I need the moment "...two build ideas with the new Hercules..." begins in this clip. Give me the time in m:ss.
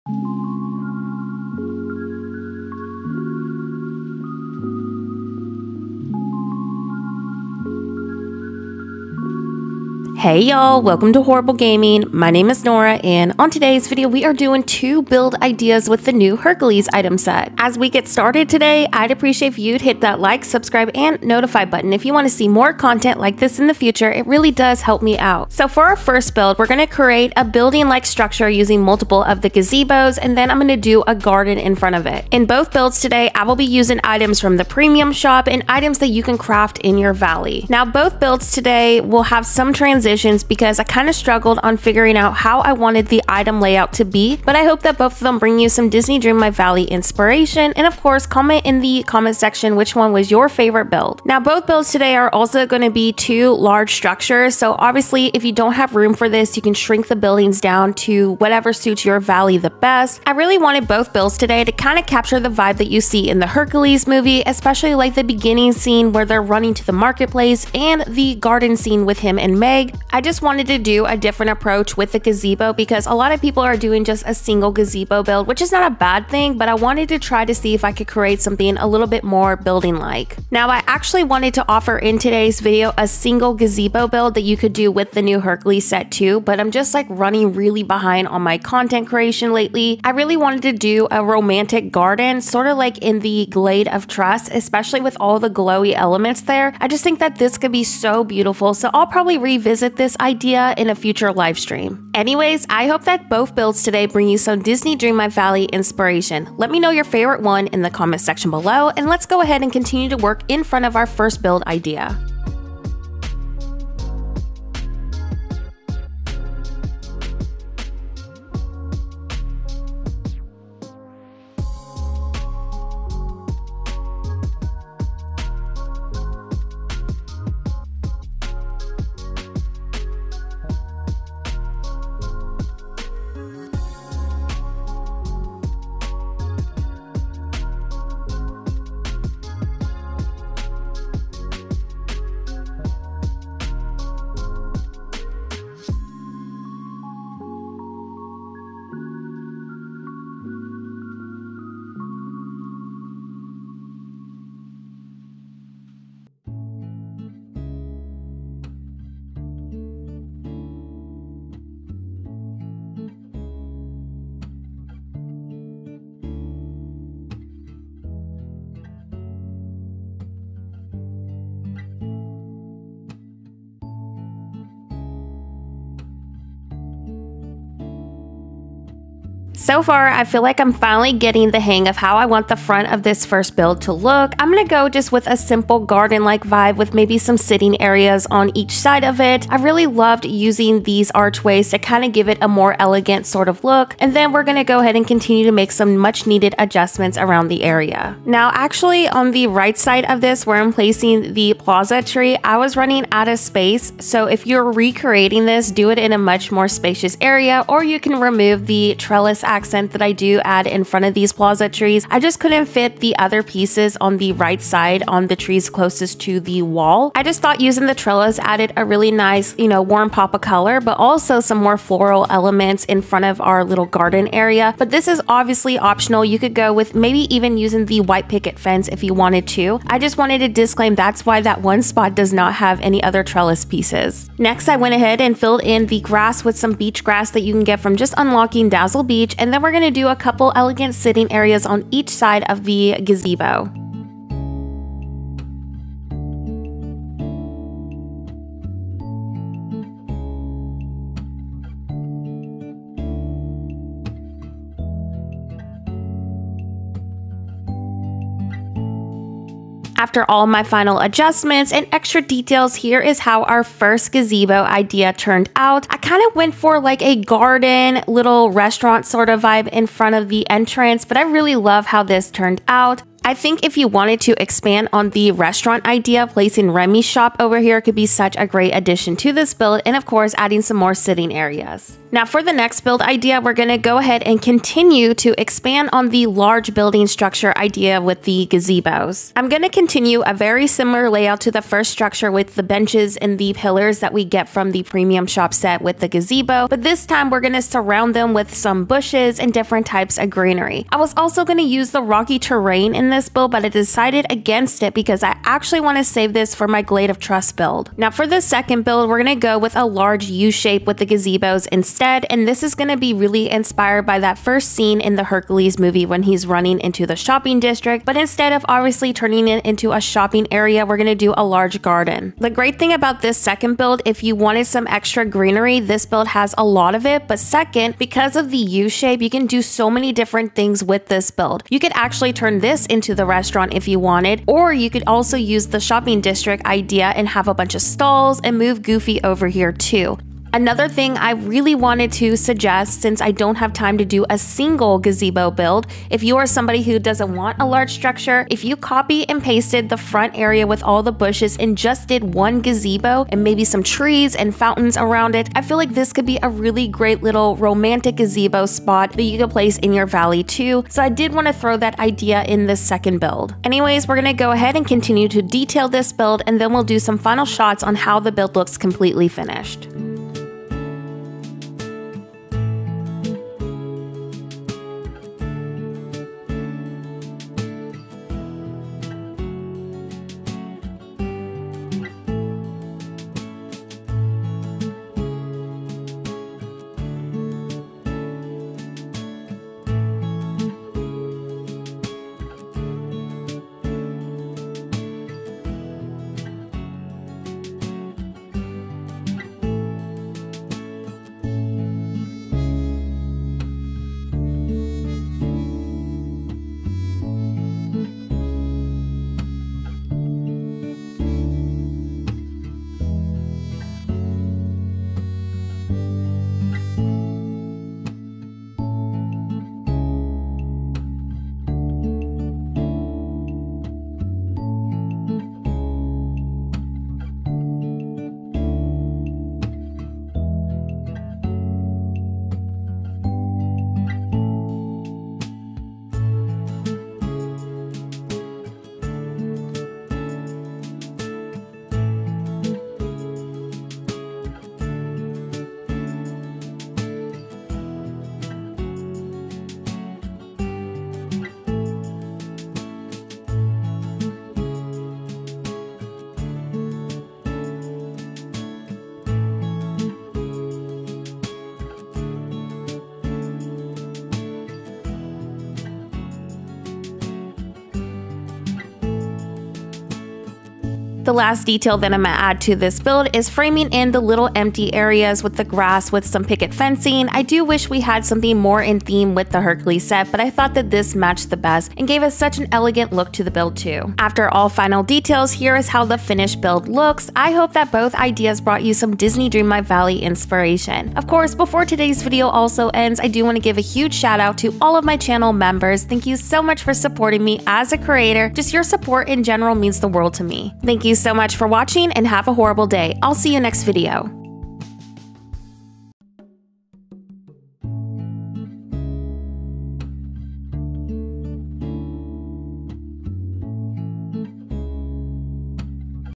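0:14.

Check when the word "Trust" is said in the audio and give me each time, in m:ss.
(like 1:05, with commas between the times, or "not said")
1:34, 5:07.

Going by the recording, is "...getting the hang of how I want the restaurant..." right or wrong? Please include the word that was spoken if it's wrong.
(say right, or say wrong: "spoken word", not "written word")
wrong: "front", not "restaurant".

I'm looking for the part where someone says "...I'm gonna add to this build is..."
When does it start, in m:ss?
7:52.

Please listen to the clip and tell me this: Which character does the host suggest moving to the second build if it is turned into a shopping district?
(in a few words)
Goofy.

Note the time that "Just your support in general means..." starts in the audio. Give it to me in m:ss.
8:18.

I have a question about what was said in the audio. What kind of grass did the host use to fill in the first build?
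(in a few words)
Beach grass.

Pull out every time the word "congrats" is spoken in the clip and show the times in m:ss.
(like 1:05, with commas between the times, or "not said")
not said.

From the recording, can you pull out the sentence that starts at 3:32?
I just couldn't fit the other pieces on the right side on the trees closest to the wall.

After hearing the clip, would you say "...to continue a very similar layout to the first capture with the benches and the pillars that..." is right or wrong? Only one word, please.
wrong.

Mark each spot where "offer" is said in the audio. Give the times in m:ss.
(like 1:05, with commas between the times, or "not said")
1:21.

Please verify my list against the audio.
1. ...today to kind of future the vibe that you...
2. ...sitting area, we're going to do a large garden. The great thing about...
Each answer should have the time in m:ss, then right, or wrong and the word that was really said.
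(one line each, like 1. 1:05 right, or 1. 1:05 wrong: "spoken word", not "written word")
1. 1:01 wrong: "capture", not "future"
2. 5:20 wrong: "shopping", not "sitting".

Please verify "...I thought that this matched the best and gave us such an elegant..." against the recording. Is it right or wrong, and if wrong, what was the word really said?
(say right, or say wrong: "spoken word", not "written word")
right.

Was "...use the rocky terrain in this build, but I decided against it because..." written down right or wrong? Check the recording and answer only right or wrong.
right.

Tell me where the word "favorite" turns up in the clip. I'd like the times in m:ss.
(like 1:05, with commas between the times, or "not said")
0:50, 1:47.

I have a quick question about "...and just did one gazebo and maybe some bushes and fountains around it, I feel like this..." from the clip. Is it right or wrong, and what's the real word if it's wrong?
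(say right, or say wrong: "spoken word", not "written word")
wrong: "trees", not "bushes".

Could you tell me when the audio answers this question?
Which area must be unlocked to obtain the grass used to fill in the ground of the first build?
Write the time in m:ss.
3:58.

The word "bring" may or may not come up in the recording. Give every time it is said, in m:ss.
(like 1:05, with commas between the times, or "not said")
0:45, 1:44.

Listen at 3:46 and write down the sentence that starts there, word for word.
You could go with maybe even using the white picket fence if you wanted to.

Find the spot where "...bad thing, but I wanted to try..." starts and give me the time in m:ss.
1:15.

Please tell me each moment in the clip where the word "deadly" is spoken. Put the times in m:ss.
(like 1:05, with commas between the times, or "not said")
not said.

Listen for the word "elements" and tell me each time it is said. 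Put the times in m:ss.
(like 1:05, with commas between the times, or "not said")
1:35, 3:42.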